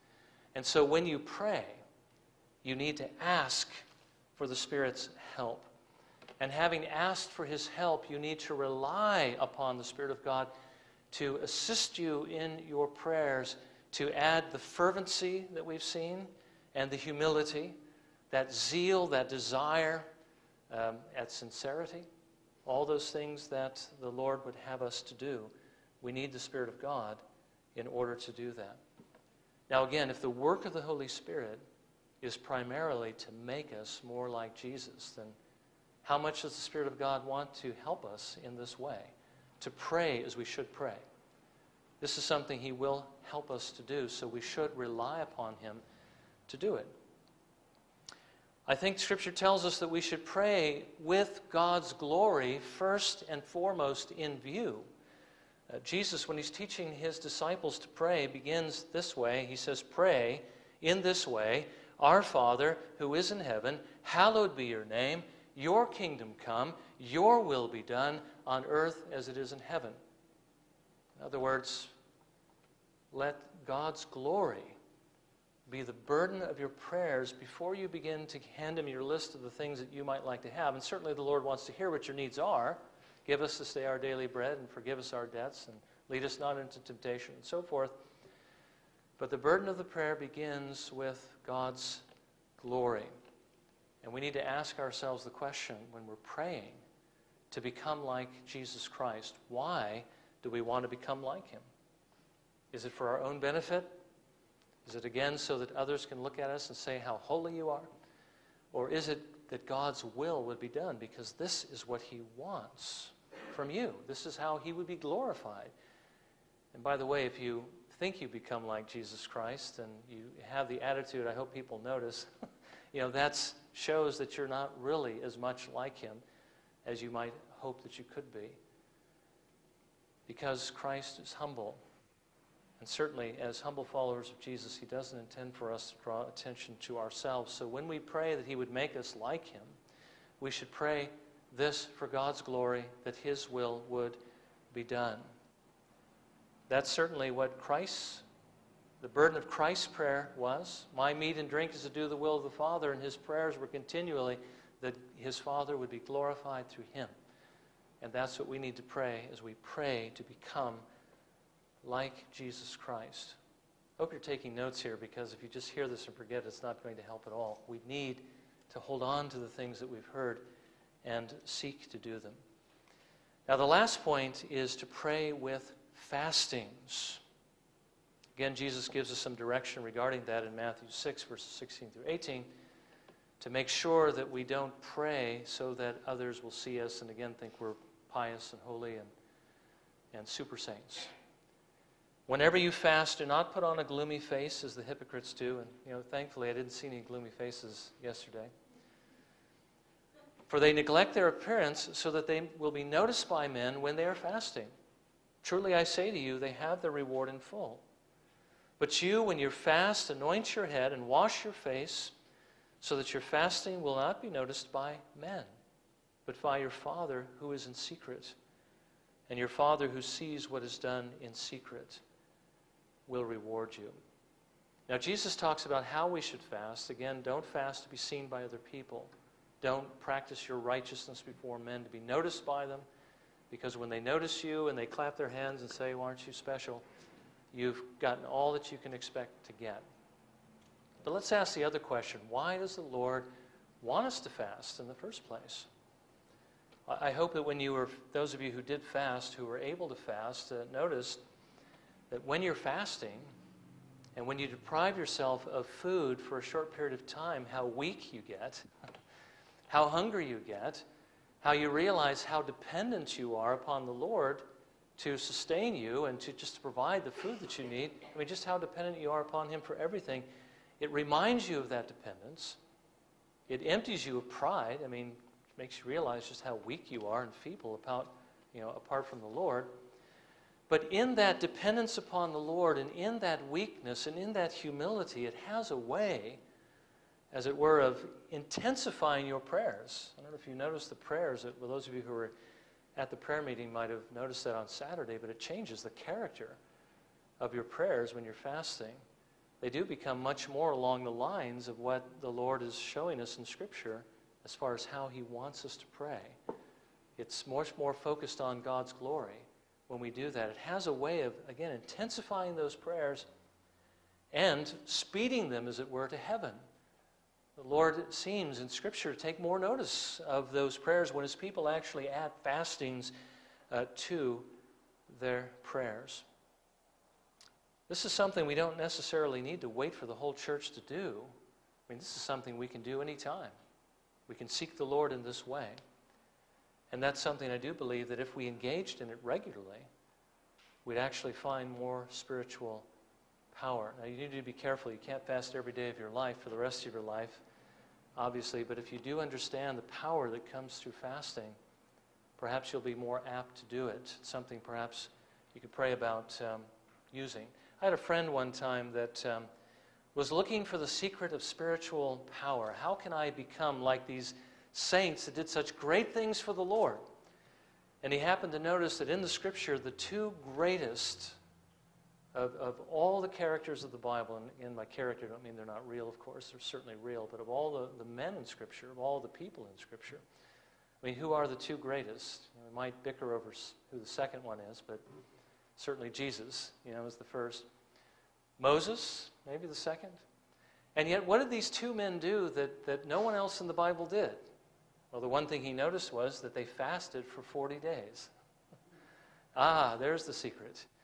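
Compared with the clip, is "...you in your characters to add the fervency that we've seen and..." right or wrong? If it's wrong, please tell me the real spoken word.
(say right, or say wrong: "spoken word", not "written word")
wrong: "prayers", not "characters".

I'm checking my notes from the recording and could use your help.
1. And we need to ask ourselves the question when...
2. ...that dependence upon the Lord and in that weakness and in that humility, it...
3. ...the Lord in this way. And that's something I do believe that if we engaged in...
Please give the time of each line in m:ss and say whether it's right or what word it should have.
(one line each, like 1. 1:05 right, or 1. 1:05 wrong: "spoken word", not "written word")
1. 1:34 right
2. 4:41 right
3. 5:34 right.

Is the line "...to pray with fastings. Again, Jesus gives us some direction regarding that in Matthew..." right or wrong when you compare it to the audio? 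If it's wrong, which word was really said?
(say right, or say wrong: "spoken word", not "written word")
right.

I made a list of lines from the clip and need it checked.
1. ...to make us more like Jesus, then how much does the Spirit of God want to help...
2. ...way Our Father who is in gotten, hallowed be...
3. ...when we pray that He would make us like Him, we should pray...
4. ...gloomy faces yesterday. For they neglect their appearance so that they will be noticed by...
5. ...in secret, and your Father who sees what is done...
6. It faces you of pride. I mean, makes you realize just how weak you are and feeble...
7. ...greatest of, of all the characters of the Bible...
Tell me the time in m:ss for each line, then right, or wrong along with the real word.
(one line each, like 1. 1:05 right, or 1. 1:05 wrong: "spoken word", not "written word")
1. 0:33 right
2. 1:01 wrong: "heaven", not "gotten"
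3. 2:17 right
4. 3:16 right
5. 3:37 right
6. 4:33 wrong: "empties", not "faces"
7. 6:10 right.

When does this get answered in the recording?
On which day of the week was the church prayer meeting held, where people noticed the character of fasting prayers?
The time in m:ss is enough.
4:54.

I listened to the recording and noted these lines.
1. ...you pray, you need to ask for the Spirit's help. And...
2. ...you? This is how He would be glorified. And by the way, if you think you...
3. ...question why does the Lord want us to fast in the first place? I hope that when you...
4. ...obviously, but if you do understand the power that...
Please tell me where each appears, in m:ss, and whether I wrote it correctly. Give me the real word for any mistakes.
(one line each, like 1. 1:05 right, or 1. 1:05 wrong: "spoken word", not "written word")
1. 0:01 right
2. 1:53 right
3. 4:01 right
4. 5:48 right.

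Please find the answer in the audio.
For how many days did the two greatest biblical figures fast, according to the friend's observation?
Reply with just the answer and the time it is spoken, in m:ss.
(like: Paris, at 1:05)
40, at 6:37.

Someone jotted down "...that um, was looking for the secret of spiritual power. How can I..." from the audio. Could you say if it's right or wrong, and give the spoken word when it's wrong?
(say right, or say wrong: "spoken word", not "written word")
right.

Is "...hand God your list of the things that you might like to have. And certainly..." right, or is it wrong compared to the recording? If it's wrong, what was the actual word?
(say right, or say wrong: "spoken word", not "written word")
wrong: "Him", not "God".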